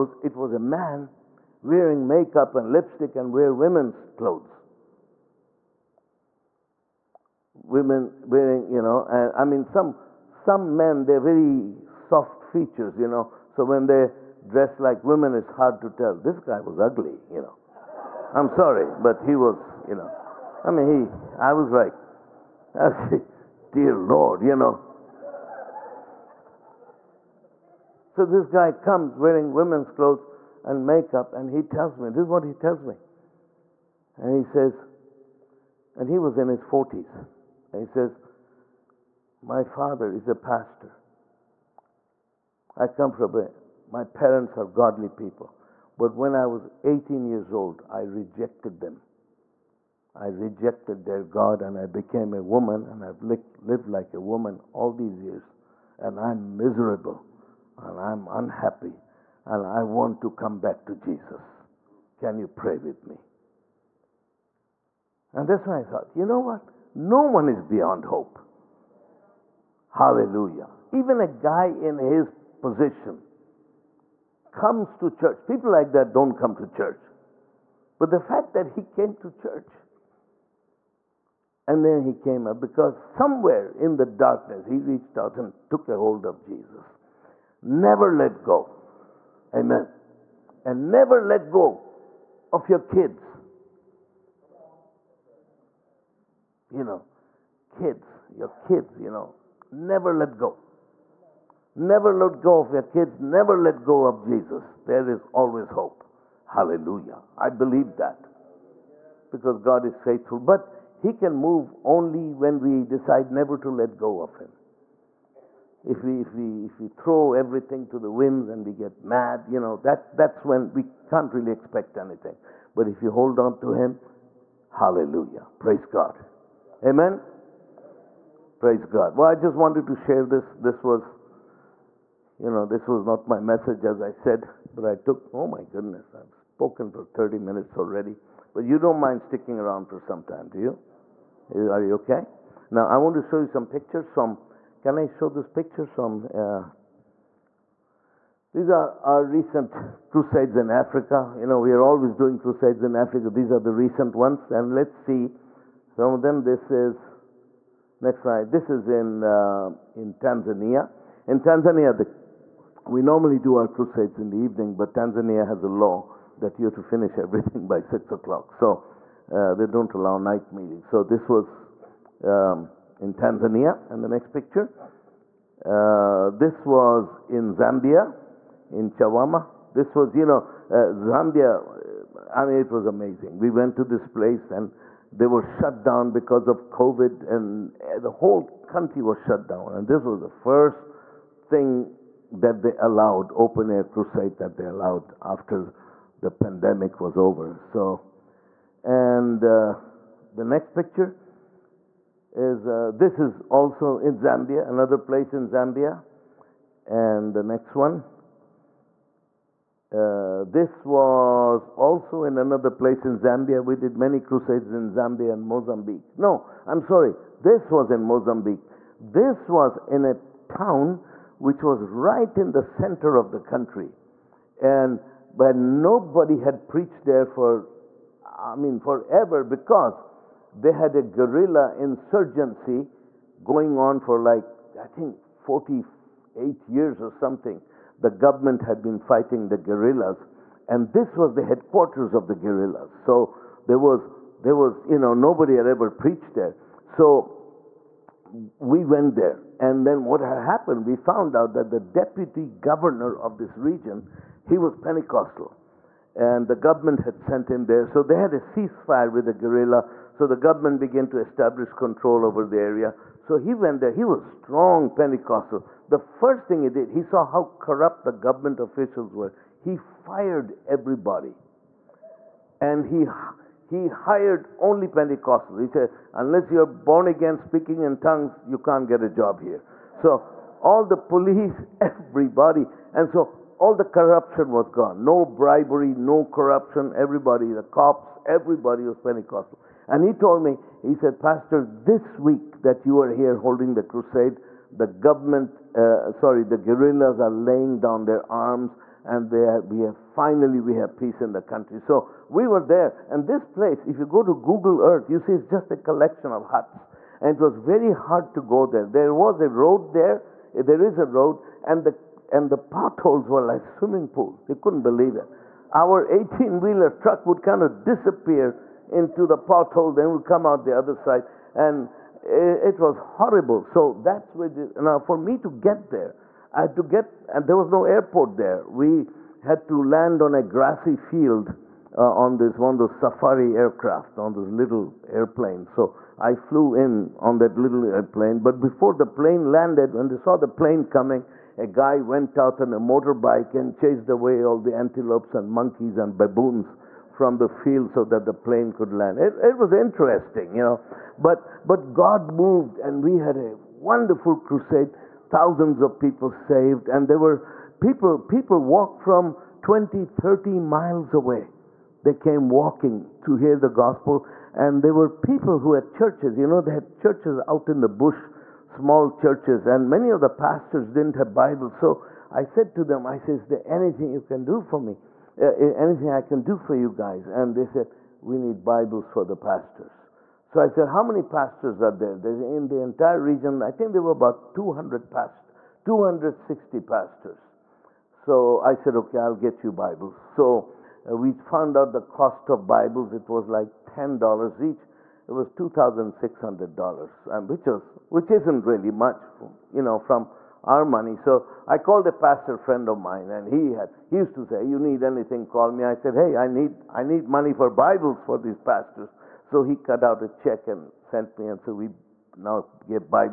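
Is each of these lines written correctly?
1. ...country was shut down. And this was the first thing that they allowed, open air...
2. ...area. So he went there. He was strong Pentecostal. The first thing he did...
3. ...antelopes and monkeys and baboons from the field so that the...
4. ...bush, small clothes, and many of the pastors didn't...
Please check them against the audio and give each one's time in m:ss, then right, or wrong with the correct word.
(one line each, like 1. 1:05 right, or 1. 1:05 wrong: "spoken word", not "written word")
1. 3:08 right
2. 4:22 right
3. 5:44 right
4. 6:07 wrong: "churches", not "clothes".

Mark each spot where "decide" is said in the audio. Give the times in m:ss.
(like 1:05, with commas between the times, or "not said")
1:52.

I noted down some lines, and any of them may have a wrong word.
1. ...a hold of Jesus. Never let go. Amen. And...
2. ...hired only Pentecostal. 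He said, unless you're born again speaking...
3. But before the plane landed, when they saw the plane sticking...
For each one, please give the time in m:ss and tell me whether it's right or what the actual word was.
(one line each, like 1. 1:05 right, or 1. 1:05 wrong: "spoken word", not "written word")
1. 1:25 right
2. 4:33 right
3. 5:38 wrong: "coming", not "sticking".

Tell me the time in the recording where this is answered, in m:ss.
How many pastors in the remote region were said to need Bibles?
6:25.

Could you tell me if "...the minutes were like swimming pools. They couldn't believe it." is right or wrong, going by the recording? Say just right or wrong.
wrong.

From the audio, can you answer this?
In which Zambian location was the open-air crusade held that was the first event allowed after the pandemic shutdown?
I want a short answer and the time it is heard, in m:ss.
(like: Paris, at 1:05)
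Chawama, at 2:58.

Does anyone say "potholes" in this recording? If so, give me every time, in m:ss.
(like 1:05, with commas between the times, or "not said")
5:12, 5:19.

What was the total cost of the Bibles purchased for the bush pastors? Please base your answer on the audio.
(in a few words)
$2,600.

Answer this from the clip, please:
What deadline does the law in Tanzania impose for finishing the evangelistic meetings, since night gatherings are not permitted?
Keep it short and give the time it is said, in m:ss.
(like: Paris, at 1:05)
6 o'clock, at 2:47.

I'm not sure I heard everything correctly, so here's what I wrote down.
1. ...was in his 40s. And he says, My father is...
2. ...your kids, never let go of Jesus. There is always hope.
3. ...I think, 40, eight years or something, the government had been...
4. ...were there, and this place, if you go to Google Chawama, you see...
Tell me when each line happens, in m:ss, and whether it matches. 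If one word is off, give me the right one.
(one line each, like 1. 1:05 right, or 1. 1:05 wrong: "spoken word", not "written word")
1. 0:36 right
2. 1:42 right
3. 3:54 right
4. 5:02 wrong: "Earth", not "Chawama".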